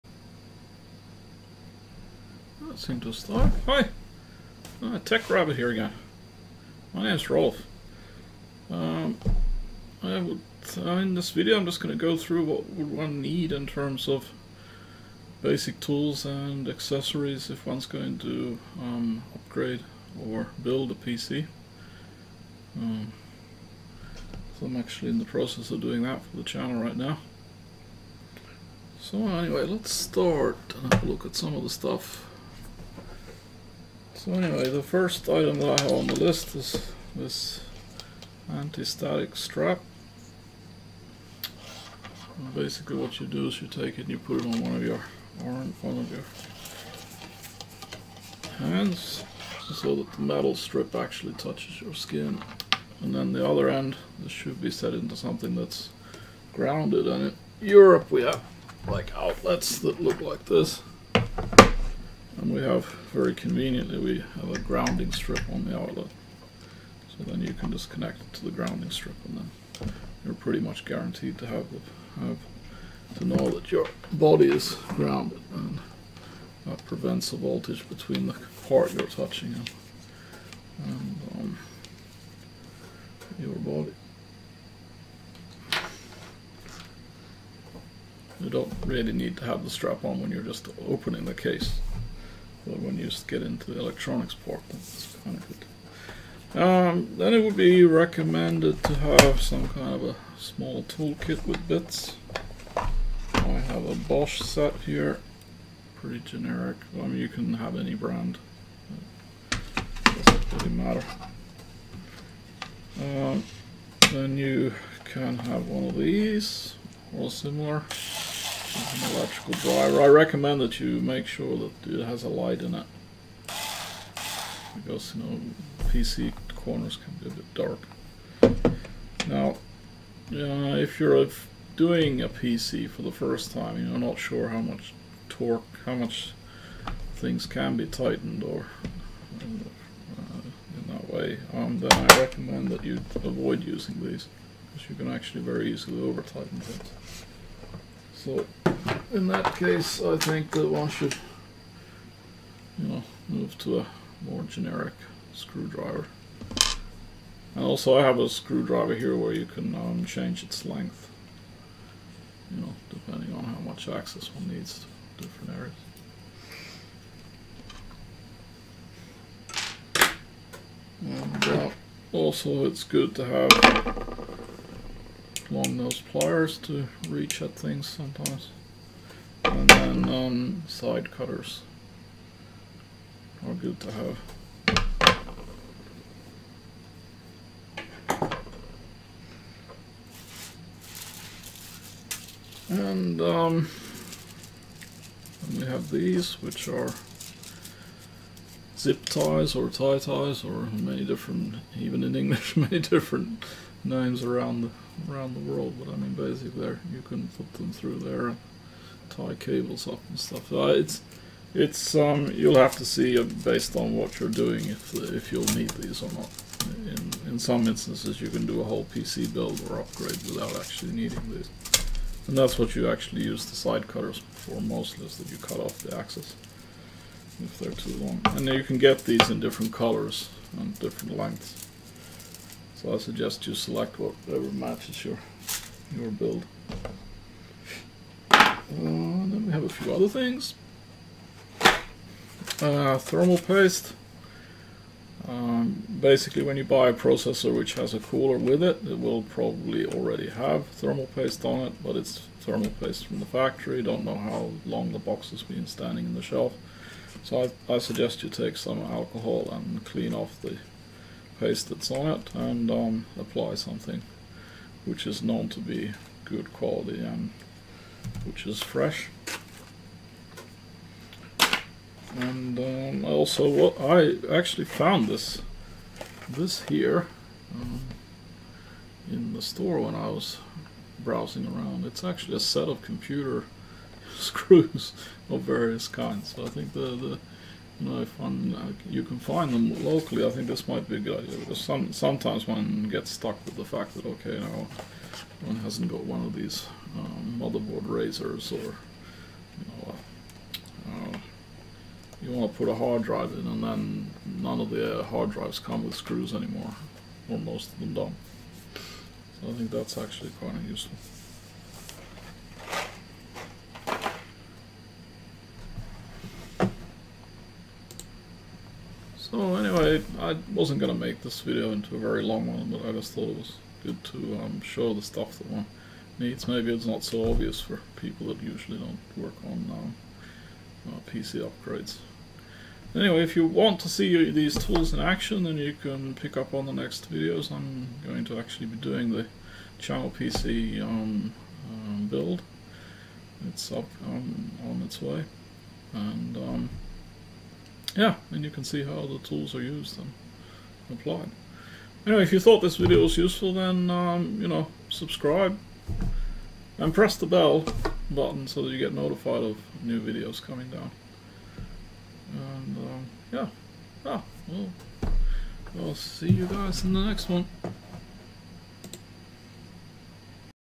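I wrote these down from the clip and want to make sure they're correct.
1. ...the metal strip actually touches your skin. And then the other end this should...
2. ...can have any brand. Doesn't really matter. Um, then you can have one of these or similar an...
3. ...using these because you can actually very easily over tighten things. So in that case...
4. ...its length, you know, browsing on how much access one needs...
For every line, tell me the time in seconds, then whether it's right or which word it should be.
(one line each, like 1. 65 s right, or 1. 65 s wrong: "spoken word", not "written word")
1. 50 s right
2. 107 s right
3. 143 s right
4. 160 s wrong: "depending", not "browsing".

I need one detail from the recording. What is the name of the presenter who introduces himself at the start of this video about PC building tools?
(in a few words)
Rolf.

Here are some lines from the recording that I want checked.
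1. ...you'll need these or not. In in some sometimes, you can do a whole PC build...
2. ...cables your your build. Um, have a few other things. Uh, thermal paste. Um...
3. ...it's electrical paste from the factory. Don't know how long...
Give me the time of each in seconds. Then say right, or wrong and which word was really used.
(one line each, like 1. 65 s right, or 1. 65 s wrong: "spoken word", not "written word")
1. 215 s wrong: "instances", not "sometimes"
2. 234 s wrong: "matches", not "cables"
3. 251 s wrong: "thermal", not "electrical".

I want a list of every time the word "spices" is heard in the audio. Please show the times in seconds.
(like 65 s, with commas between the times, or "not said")
not said.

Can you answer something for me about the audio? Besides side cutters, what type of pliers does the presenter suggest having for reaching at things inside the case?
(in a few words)
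Long-nosed pliers.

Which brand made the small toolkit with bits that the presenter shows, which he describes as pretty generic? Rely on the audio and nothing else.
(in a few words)
Bosch.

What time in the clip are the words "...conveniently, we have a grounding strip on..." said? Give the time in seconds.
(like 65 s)
63 s.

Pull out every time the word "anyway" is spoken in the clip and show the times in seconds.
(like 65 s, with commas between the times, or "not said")
29 s, 34 s, 319 s, 332 s, 352 s.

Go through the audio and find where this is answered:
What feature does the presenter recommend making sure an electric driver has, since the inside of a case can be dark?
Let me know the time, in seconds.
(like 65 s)
122 s.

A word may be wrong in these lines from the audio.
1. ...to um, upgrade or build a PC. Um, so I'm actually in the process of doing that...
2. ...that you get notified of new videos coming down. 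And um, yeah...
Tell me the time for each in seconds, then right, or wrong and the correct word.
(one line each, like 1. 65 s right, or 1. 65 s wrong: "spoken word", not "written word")
1. 18 s right
2. 358 s right.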